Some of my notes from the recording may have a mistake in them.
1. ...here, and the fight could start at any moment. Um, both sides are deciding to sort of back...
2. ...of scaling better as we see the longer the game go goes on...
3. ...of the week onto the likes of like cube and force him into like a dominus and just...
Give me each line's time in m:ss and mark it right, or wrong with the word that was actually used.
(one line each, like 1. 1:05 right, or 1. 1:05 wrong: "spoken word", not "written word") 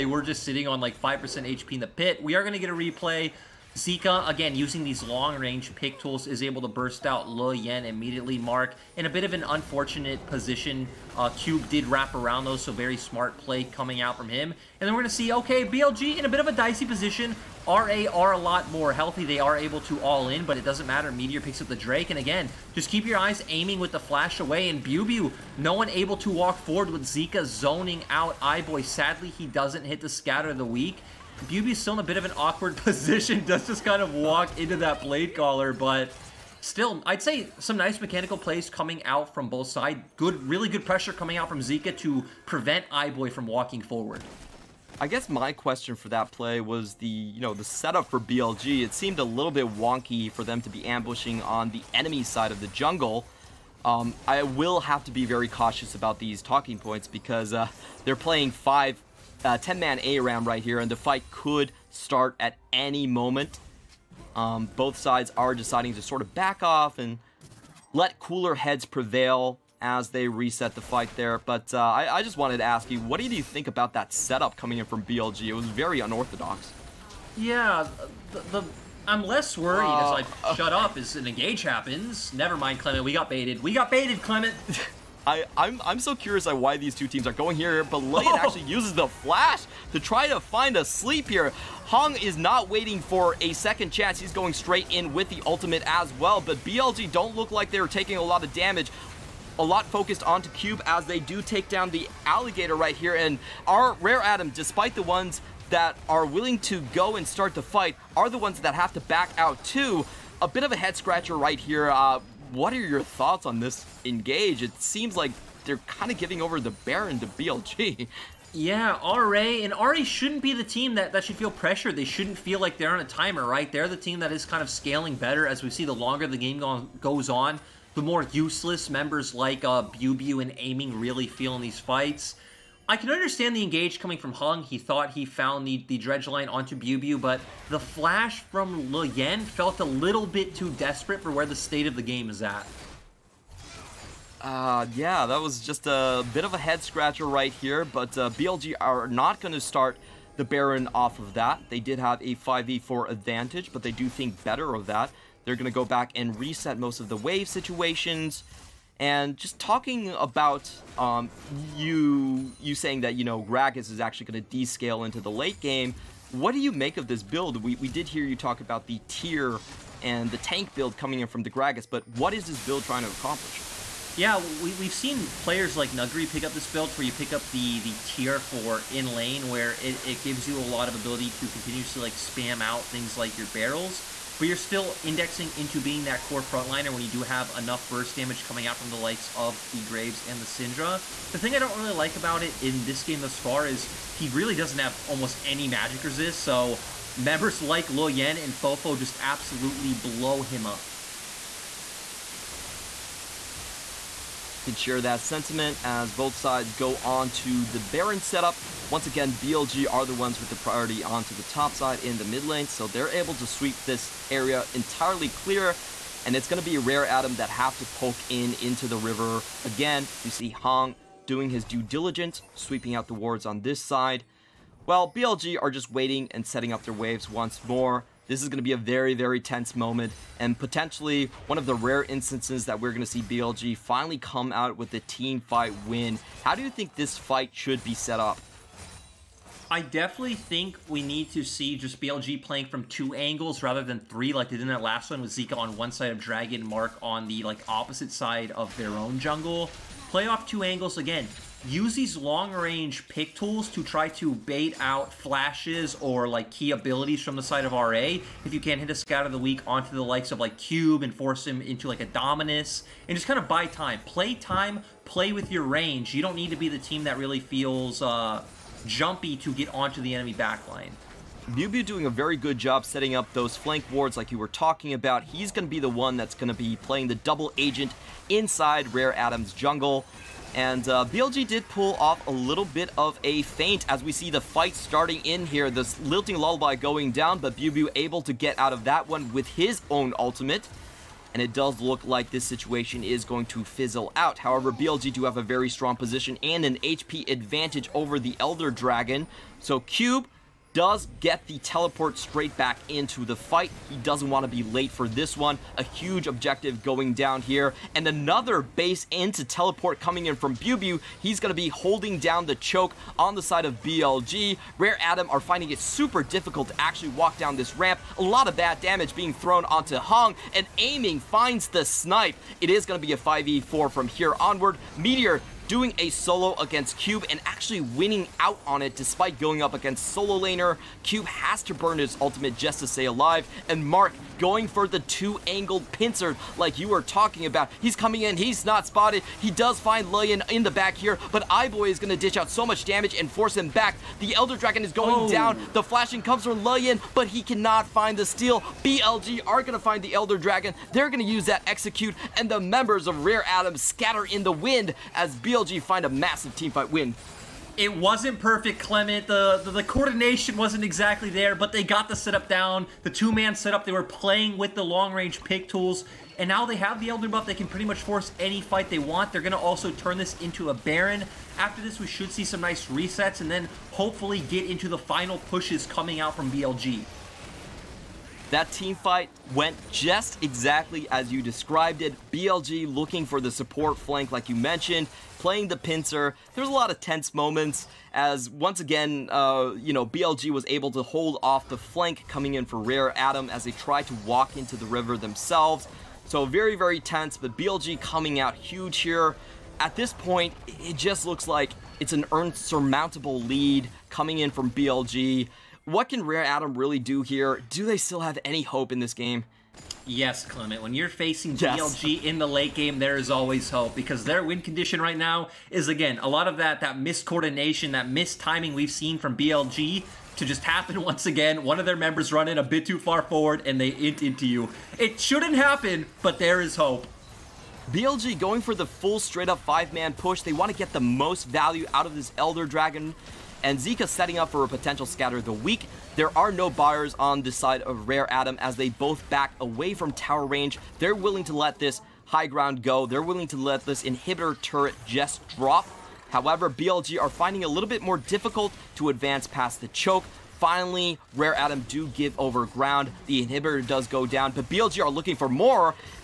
1. 1:00 right
2. 2:04 right
3. 4:19 right.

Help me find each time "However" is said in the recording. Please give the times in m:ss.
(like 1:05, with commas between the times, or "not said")
4:54, 7:26.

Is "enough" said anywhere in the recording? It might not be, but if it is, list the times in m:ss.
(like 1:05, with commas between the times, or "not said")
3:07.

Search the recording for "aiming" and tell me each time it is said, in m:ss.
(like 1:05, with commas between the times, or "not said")
0:23, 2:10, 5:20.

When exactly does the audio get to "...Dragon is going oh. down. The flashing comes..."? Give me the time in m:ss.
5:44.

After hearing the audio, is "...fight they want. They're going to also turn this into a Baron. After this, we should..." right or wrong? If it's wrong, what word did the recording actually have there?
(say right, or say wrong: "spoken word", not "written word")
right.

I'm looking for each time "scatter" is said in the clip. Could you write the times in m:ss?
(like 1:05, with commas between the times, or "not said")
0:30, 5:53, 7:15.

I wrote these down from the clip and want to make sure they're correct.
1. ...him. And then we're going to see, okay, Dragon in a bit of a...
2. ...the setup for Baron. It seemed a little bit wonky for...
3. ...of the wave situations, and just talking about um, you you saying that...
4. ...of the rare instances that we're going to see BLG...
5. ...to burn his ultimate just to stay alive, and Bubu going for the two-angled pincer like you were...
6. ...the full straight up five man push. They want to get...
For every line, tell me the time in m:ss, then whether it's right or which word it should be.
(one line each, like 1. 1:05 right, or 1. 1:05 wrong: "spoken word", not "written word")
1. 0:14 wrong: "BLG", not "Dragon"
2. 0:47 wrong: "BLG", not "Baron"
3. 2:37 right
4. 3:51 right
5. 5:31 wrong: "Mark", not "Bubu"
6. 7:08 right.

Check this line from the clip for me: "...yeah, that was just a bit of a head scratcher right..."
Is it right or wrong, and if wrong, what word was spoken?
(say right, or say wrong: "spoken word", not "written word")
right.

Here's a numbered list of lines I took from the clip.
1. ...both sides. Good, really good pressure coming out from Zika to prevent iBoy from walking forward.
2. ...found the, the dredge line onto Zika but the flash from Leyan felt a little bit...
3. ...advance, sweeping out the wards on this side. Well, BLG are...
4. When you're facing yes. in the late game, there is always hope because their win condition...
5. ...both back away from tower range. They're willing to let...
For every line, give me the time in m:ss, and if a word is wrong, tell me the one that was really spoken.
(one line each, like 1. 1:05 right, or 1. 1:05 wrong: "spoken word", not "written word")
1. 0:39 right
2. 2:15 wrong: "Biu", not "Zika"
3. 3:41 wrong: "diligence", not "advance"
4. 6:50 right
5. 7:18 right.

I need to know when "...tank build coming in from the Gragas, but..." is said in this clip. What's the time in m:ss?
2:50.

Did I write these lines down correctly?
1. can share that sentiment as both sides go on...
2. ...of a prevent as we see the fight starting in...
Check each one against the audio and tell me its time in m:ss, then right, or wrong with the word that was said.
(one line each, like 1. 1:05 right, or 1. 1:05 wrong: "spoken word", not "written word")
1. 3:24 right
2. 4:42 wrong: "feint", not "prevent".